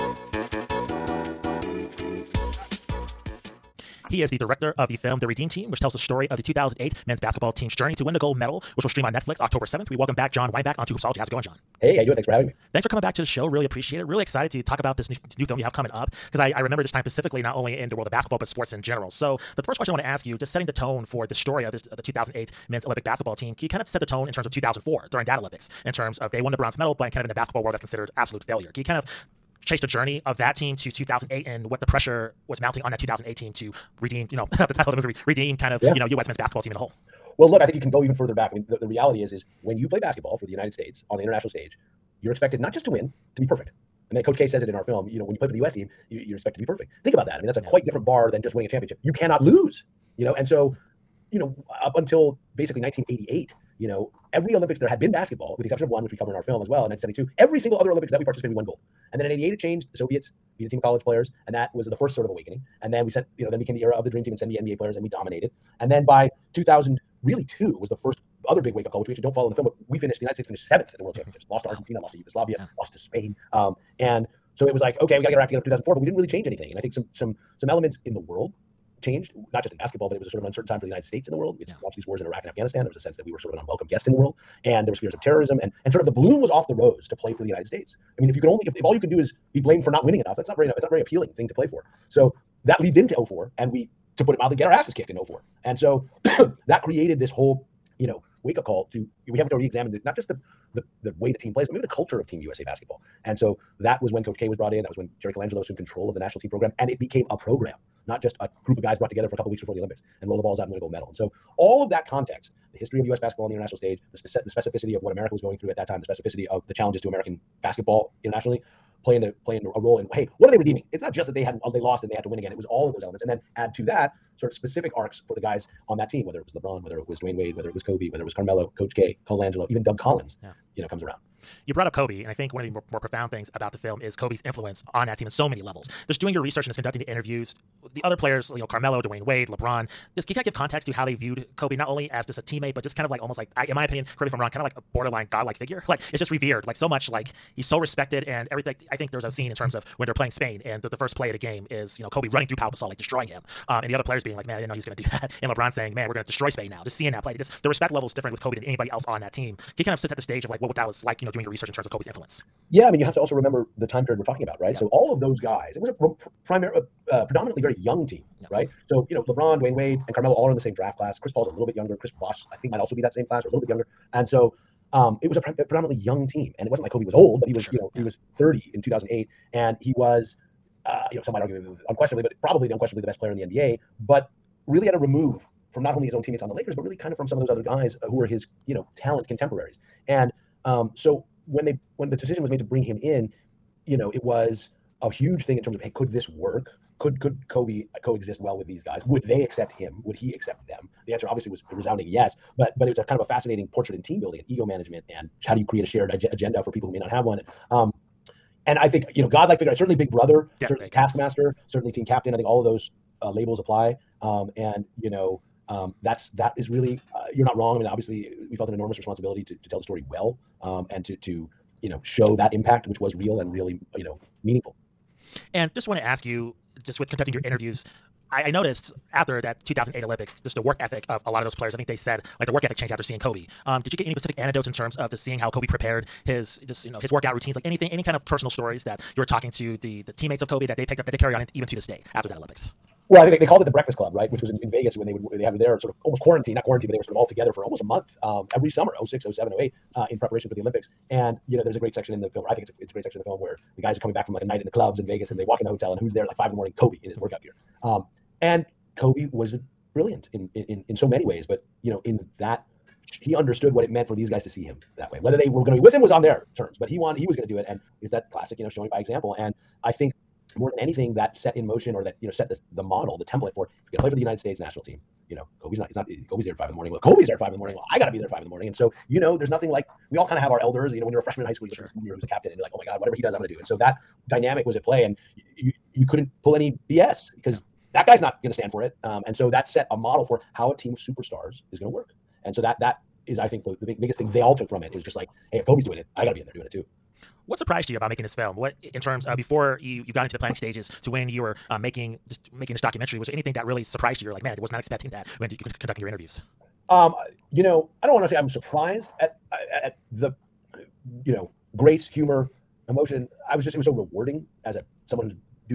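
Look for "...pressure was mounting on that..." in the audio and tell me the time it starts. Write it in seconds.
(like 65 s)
31 s.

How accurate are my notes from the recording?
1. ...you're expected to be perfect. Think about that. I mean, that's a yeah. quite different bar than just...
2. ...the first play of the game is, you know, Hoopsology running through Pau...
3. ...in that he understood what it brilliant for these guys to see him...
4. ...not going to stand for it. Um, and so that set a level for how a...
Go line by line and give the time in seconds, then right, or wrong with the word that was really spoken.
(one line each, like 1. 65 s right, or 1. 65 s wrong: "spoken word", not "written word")
1. 46 s right
2. 150 s wrong: "Kobe", not "Hoopsology"
3. 262 s wrong: "meant", not "brilliant"
4. 288 s wrong: "model", not "level".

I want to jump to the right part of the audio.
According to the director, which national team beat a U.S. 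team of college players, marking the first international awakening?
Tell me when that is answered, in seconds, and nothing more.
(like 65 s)
59 s.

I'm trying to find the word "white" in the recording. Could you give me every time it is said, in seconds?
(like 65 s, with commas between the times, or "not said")
not said.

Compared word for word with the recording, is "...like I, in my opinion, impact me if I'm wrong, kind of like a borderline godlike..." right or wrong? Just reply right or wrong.
wrong.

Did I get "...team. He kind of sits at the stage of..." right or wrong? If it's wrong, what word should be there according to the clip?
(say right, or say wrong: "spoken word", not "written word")
right.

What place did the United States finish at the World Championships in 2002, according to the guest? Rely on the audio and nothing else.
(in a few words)
7th.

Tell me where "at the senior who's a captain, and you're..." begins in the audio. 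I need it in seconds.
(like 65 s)
281 s.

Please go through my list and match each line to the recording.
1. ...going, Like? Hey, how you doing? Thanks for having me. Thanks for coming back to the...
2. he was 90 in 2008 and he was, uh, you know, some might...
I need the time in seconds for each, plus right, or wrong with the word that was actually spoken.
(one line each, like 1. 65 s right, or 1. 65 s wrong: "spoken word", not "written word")
1. 11 s wrong: "Jon", not "Like"
2. 177 s wrong: "30", not "90".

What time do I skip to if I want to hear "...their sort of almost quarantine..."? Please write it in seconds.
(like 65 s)
245 s.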